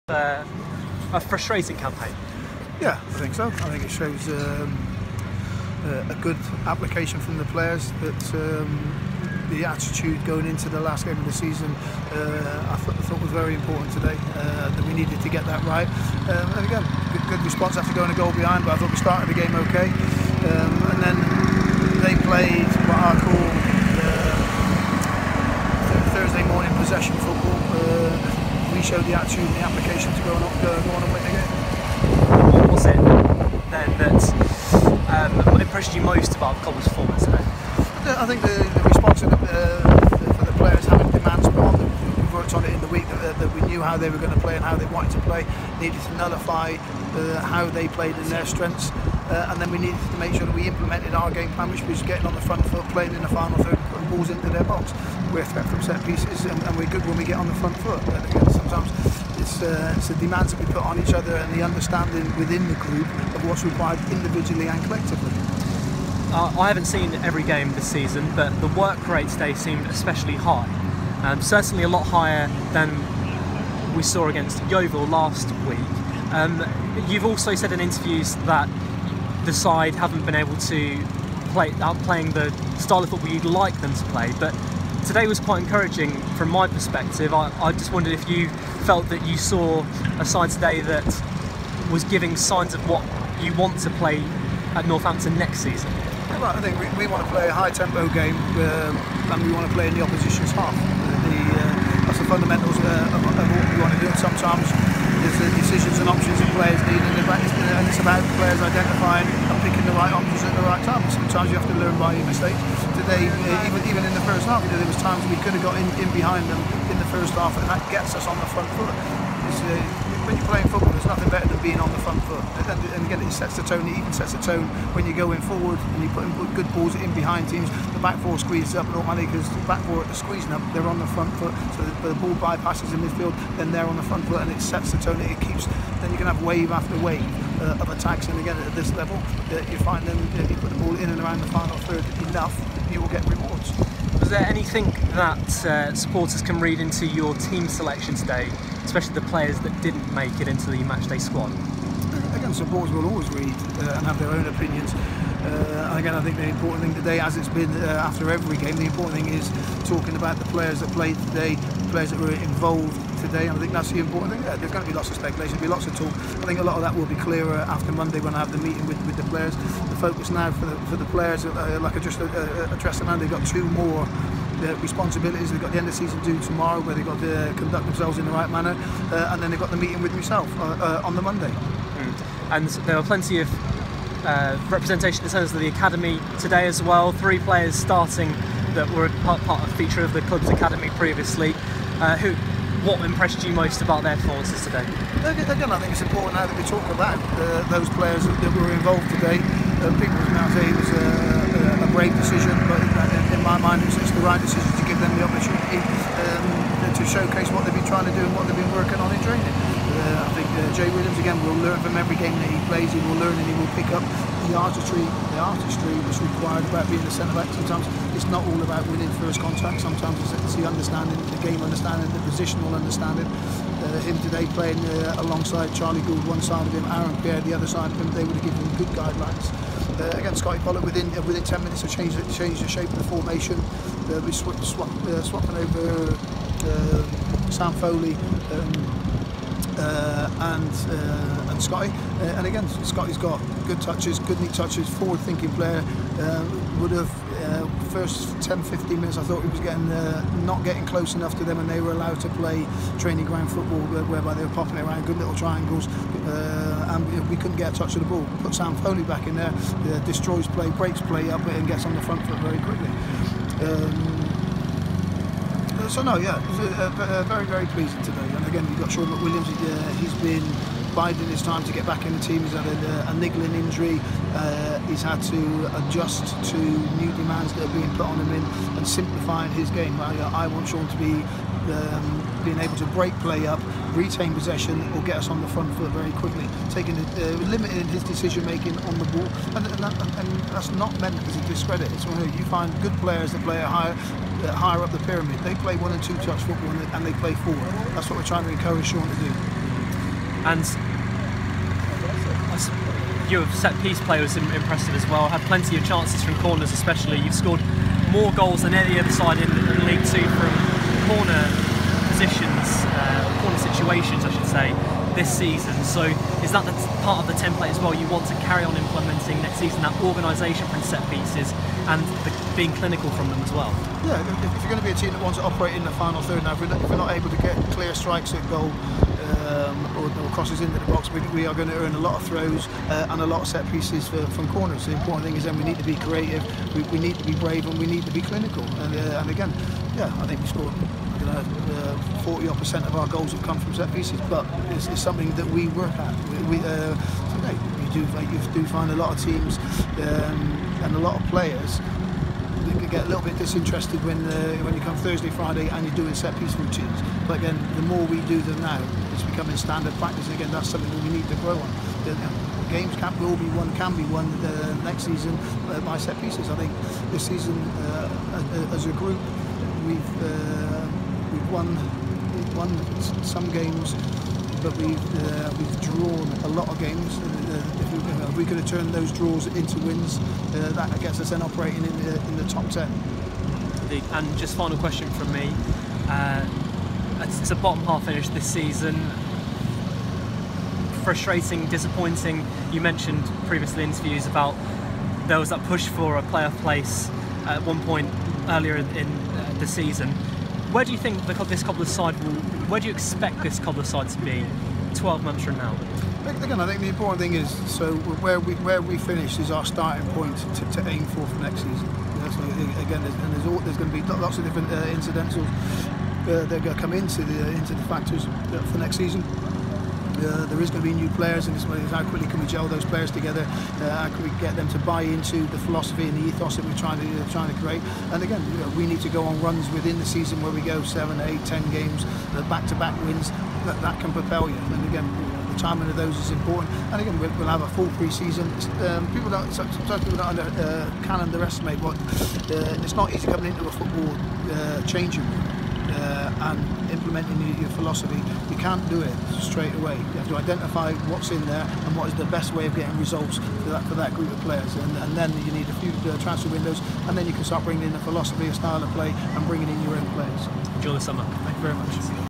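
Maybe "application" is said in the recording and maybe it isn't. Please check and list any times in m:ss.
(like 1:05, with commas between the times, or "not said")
0:06, 0:29.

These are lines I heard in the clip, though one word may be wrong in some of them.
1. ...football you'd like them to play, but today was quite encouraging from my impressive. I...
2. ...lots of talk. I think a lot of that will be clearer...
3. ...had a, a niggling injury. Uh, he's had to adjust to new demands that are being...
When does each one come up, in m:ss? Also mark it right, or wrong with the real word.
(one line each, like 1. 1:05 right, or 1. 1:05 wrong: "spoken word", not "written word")
1. 1:23 wrong: "perspective", not "impressive"
2. 2:45 right
3. 4:32 right.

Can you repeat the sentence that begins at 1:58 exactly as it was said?
Uh, when you're playing football, there's nothing better than being on the front foot.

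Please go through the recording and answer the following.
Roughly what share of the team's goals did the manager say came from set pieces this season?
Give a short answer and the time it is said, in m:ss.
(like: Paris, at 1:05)
40 odd percent, at 5:42.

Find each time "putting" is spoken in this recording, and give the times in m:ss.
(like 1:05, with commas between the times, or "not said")
0:53, 2:06.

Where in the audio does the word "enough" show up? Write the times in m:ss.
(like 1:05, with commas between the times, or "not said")
2:22, 4:11.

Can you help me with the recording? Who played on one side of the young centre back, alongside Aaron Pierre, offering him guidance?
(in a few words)
Charlie Goode.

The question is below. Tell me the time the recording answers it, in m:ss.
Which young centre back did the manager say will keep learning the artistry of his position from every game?
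3:30.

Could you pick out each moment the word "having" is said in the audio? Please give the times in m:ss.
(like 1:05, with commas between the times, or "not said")
0:40.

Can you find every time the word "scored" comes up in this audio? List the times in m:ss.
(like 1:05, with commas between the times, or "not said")
5:07, 5:40.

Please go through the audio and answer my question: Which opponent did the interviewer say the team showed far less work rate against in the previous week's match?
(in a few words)
Yeovil.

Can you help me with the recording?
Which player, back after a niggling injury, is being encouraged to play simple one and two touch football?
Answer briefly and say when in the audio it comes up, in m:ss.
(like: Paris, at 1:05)
Shaun McWilliams, at 4:28.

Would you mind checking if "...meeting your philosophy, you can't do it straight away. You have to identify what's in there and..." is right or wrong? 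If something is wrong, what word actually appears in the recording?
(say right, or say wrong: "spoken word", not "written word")
wrong: "implementing", not "meeting".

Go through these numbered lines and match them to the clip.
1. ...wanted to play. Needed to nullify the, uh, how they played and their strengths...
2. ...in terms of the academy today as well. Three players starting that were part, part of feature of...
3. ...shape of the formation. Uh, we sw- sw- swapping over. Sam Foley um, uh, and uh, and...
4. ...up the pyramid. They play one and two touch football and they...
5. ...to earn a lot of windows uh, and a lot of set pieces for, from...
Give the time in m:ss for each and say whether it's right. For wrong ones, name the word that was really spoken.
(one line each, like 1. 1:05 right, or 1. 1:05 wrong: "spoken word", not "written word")
1. 0:44 right
2. 3:05 right
3. 3:52 right
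4. 4:54 right
5. 5:31 wrong: "throws", not "windows".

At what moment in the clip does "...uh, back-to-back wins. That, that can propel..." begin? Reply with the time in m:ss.
7:12.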